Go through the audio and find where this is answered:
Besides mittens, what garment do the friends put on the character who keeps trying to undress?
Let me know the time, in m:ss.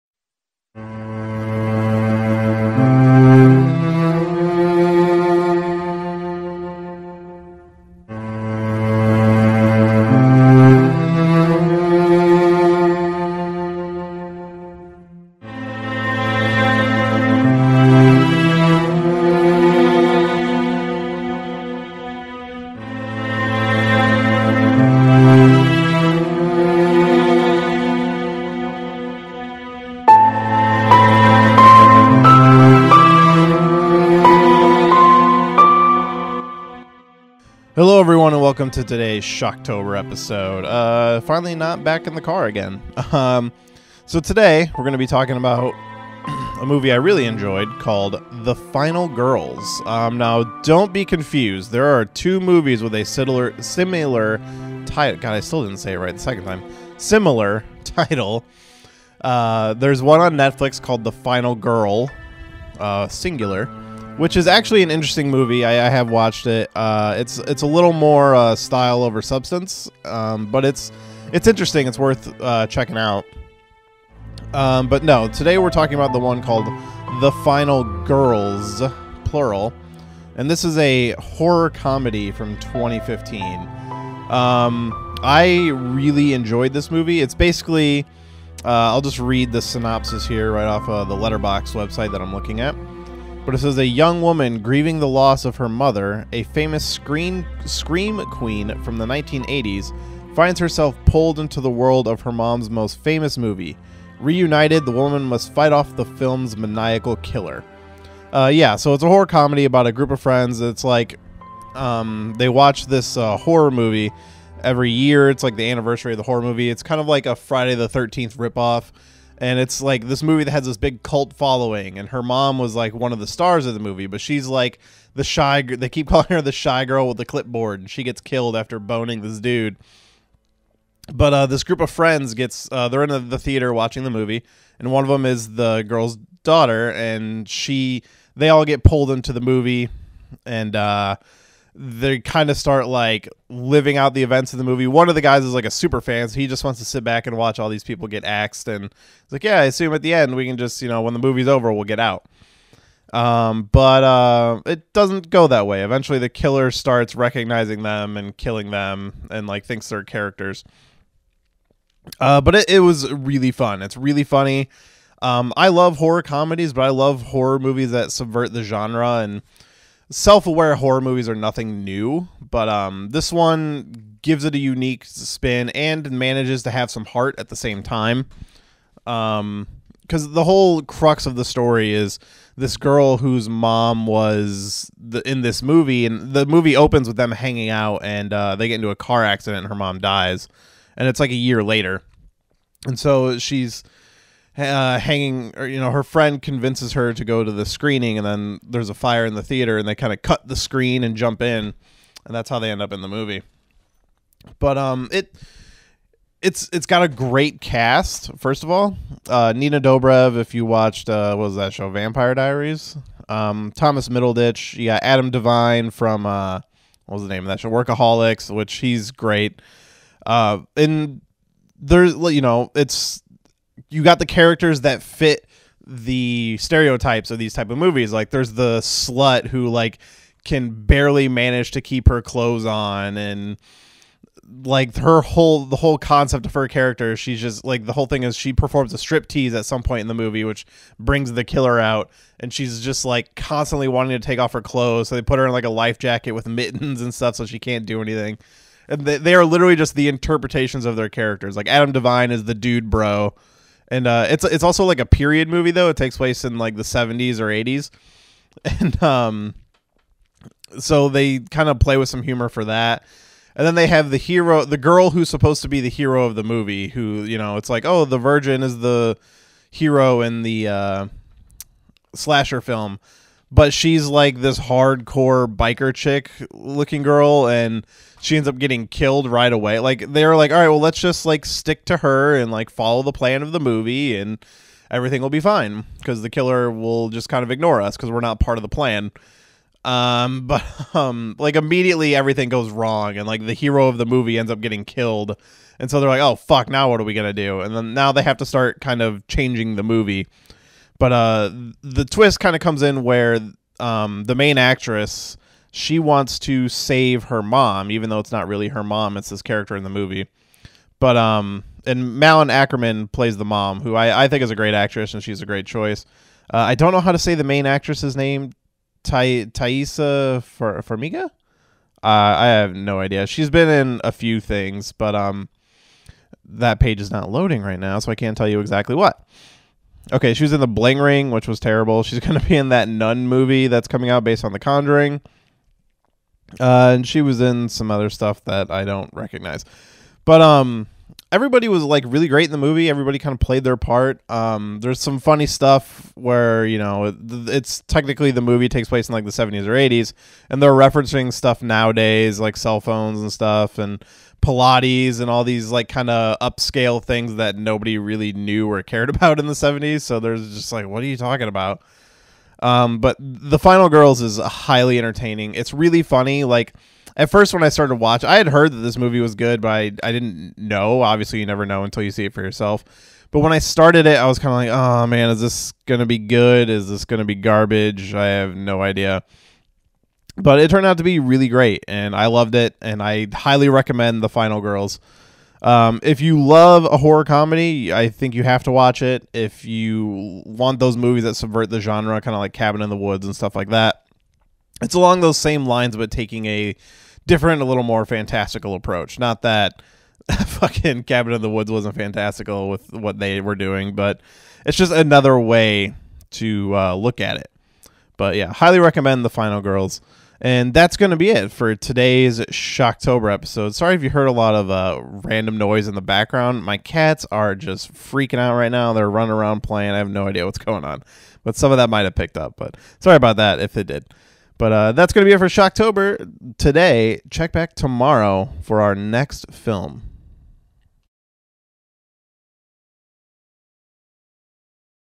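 4:05.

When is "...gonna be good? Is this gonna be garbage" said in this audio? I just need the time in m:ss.
6:15.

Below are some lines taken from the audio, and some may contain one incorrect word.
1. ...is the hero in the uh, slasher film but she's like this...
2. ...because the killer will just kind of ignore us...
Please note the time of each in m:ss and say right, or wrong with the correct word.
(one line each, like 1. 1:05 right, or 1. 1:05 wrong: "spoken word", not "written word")
1. 4:28 right
2. 4:45 right.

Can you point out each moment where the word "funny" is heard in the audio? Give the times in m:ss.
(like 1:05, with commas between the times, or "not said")
2:44, 5:45, 6:06.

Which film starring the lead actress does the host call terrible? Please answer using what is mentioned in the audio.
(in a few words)
The Bling Ring.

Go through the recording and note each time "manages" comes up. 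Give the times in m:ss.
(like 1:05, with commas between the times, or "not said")
2:56, 3:51.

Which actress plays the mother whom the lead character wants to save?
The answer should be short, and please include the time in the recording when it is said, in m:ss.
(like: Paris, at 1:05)
Malin Akerman, at 5:12.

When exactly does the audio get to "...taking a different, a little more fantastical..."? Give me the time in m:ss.
6:36.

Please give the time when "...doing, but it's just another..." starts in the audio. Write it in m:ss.
6:43.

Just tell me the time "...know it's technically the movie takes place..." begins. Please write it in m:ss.
5:46.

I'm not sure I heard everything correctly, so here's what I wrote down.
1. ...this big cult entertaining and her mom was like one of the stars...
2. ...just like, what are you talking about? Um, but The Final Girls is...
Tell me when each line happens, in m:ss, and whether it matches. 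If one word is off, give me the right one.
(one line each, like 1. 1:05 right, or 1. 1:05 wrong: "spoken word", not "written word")
1. 2:00 wrong: "following", not "entertaining"
2. 6:00 right.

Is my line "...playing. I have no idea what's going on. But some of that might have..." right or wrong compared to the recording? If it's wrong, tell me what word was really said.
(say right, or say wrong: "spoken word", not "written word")
right.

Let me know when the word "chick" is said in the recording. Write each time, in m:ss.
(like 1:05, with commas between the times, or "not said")
4:35.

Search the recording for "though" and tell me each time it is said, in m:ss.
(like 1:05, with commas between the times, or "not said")
4:15, 5:08.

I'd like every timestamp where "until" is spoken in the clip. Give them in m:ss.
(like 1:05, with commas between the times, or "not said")
6:11.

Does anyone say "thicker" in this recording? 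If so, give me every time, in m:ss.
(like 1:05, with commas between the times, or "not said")
not said.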